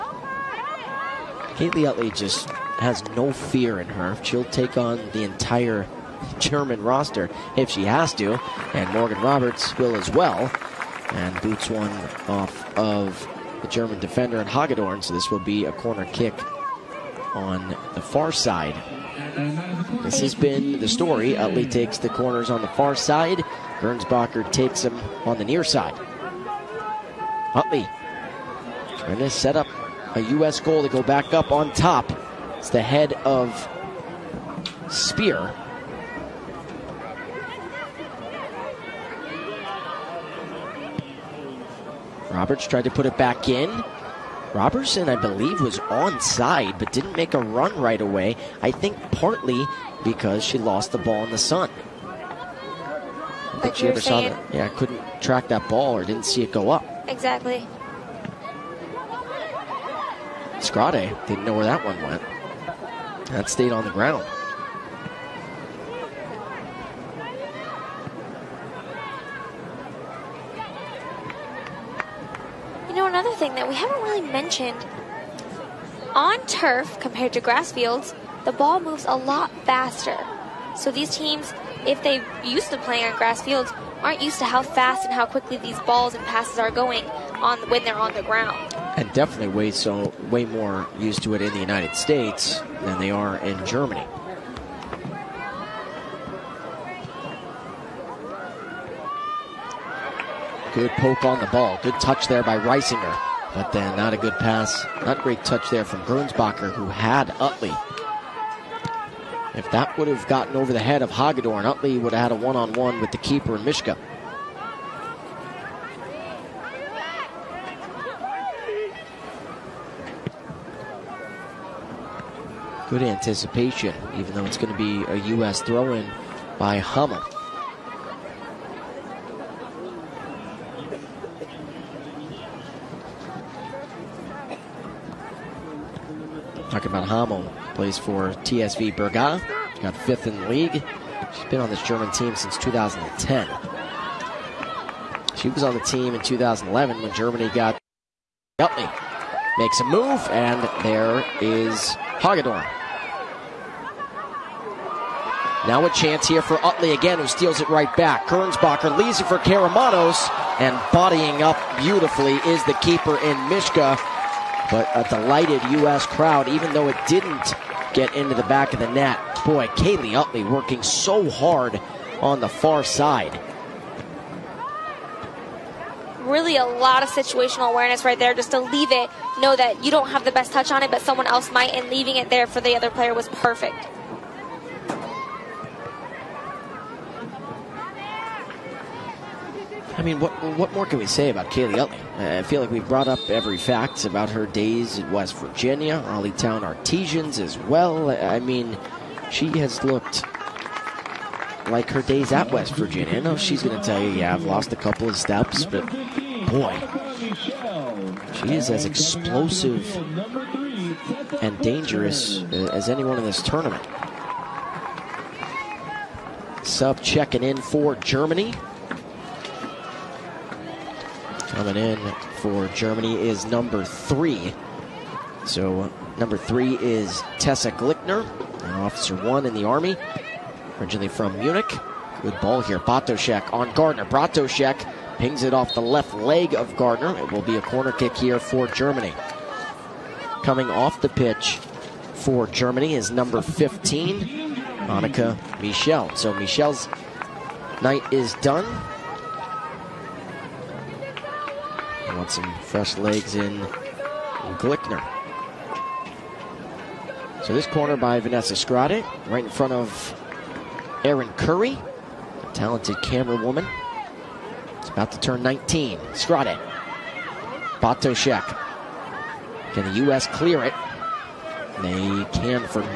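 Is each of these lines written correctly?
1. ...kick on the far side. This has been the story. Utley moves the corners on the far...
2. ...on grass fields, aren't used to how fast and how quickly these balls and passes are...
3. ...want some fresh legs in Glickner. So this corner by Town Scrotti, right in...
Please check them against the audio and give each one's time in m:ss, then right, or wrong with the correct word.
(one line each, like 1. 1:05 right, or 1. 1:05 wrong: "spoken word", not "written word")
1. 0:16 wrong: "takes", not "moves"
2. 1:23 right
3. 4:12 wrong: "Vanessa", not "Town".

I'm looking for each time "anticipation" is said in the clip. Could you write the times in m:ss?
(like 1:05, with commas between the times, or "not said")
2:03.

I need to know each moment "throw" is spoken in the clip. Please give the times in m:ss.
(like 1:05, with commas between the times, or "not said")
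2:05.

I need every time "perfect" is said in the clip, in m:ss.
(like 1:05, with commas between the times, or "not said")
3:03.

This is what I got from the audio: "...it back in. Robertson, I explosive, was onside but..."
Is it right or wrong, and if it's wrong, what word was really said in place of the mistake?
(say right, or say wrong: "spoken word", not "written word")
wrong: "believe", not "explosive".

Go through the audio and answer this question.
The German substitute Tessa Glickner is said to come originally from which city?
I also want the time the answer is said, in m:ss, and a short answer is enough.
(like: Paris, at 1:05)
Munich, at 3:50.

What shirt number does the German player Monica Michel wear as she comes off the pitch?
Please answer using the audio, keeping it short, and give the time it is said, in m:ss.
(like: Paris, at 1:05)
15, at 4:03.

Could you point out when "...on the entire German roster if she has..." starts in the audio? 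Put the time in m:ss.
0:04.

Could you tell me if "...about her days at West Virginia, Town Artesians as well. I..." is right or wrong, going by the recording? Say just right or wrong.
right.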